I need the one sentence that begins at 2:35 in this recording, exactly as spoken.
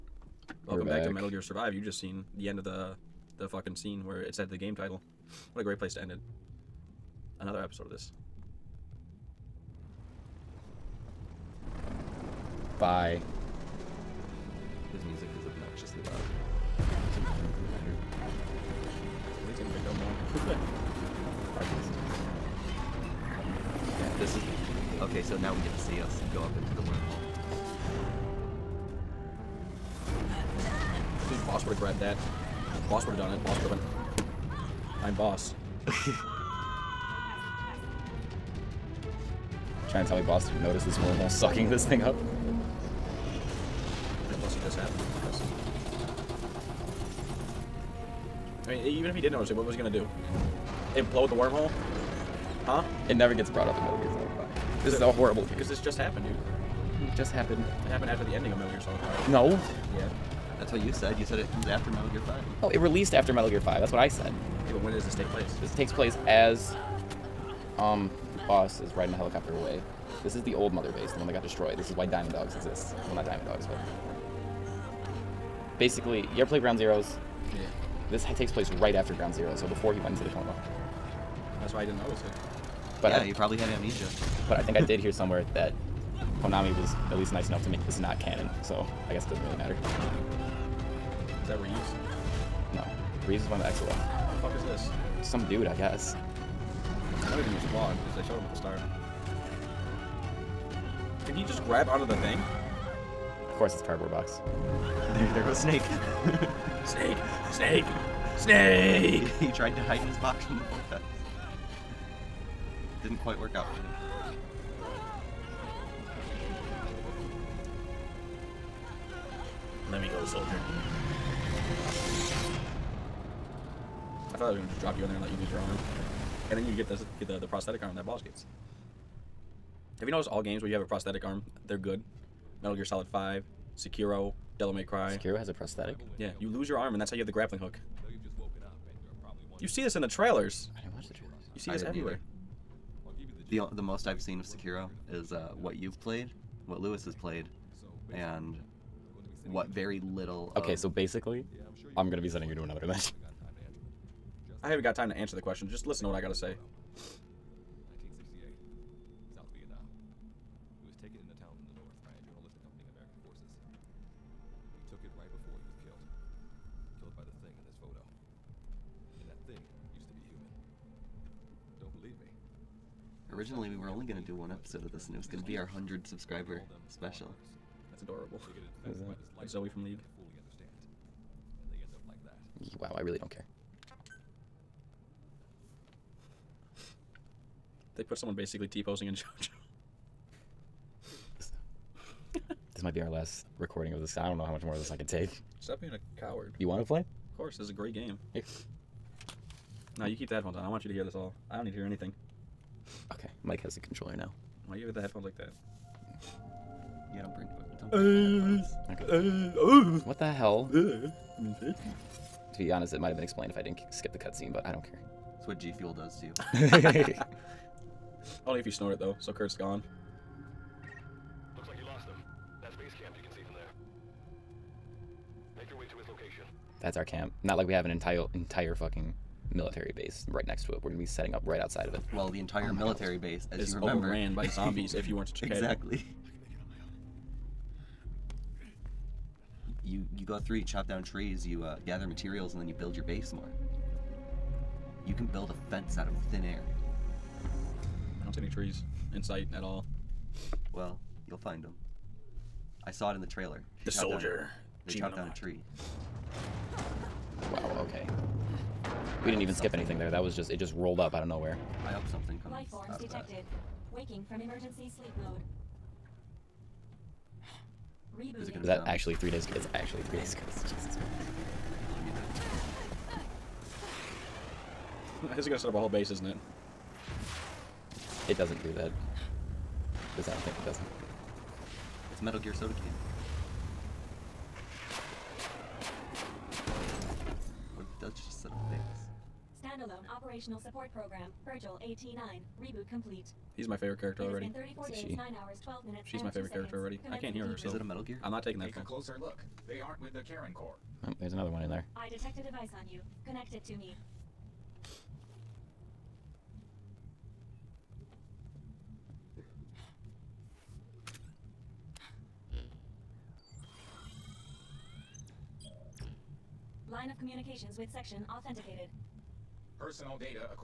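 Just listen to what I gotta say.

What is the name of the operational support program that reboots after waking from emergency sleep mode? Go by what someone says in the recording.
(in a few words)
Virgil AT-9.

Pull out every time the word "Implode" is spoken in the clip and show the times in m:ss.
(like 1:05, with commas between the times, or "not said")
0:50.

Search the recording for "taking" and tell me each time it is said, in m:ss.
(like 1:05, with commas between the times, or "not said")
4:58.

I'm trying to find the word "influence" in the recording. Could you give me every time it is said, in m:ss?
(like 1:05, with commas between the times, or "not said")
not said.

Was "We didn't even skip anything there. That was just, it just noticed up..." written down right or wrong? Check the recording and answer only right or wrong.
wrong.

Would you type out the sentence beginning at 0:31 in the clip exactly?
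Dude, boss would have grabbed that.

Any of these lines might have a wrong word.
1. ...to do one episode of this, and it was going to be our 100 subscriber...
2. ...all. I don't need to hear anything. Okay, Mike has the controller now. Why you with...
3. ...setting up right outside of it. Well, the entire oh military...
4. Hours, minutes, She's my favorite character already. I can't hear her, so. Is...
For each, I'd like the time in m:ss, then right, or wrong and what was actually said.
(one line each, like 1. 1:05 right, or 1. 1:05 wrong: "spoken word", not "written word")
1. 2:54 right
2. 3:21 right
3. 3:51 right
4. 4:55 right.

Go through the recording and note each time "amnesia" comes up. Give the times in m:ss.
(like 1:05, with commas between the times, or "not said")
1:23.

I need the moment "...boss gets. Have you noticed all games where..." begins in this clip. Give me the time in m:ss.
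2:08.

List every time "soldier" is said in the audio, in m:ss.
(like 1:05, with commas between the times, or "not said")
2:00, 4:13.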